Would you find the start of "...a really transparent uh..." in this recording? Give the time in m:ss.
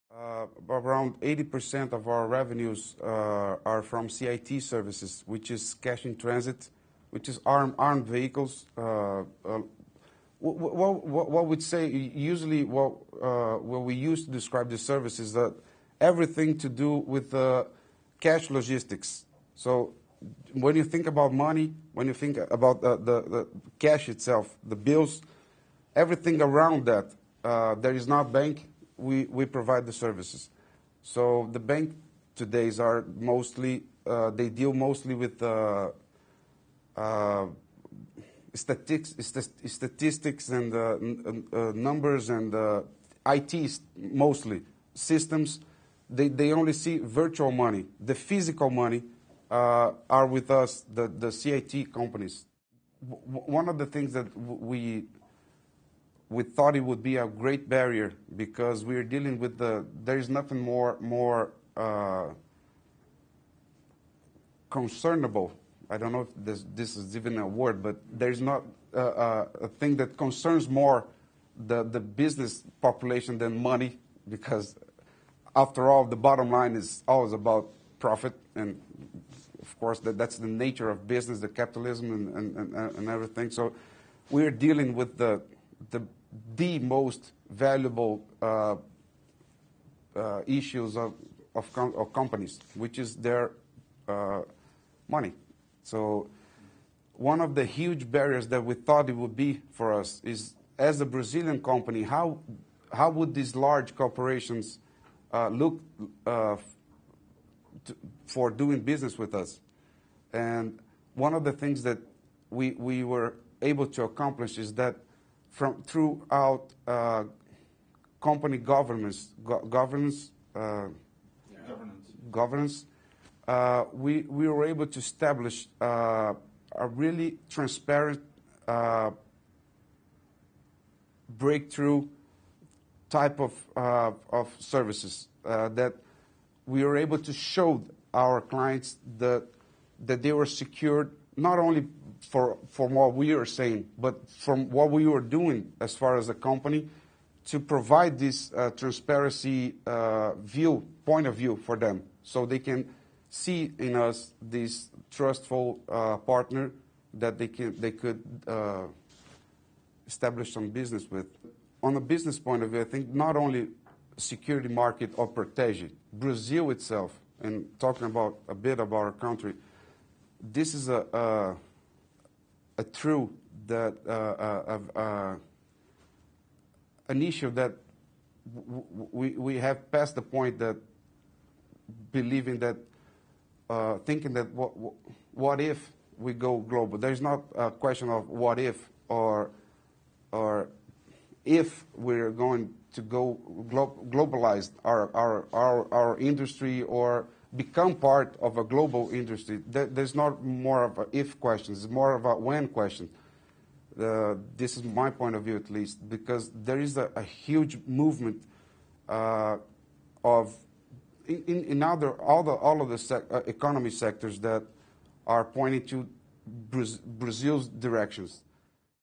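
2:06.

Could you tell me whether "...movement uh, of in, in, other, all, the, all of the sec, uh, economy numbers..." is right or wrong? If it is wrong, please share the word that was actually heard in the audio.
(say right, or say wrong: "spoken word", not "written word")
wrong: "sectors", not "numbers".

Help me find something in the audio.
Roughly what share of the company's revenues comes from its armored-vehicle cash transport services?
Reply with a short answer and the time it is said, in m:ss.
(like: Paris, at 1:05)
80%, at 0:01.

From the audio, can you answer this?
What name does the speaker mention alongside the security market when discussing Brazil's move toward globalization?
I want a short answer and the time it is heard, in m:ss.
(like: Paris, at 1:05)
Protege, at 2:45.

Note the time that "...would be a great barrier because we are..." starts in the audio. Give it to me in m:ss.
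0:56.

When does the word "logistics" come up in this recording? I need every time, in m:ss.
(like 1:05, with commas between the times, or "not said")
0:18.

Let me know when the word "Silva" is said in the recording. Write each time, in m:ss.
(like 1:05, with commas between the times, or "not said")
not said.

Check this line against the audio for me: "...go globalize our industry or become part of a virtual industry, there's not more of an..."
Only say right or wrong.
wrong.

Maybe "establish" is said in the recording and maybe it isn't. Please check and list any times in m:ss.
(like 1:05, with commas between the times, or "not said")
2:04, 2:40.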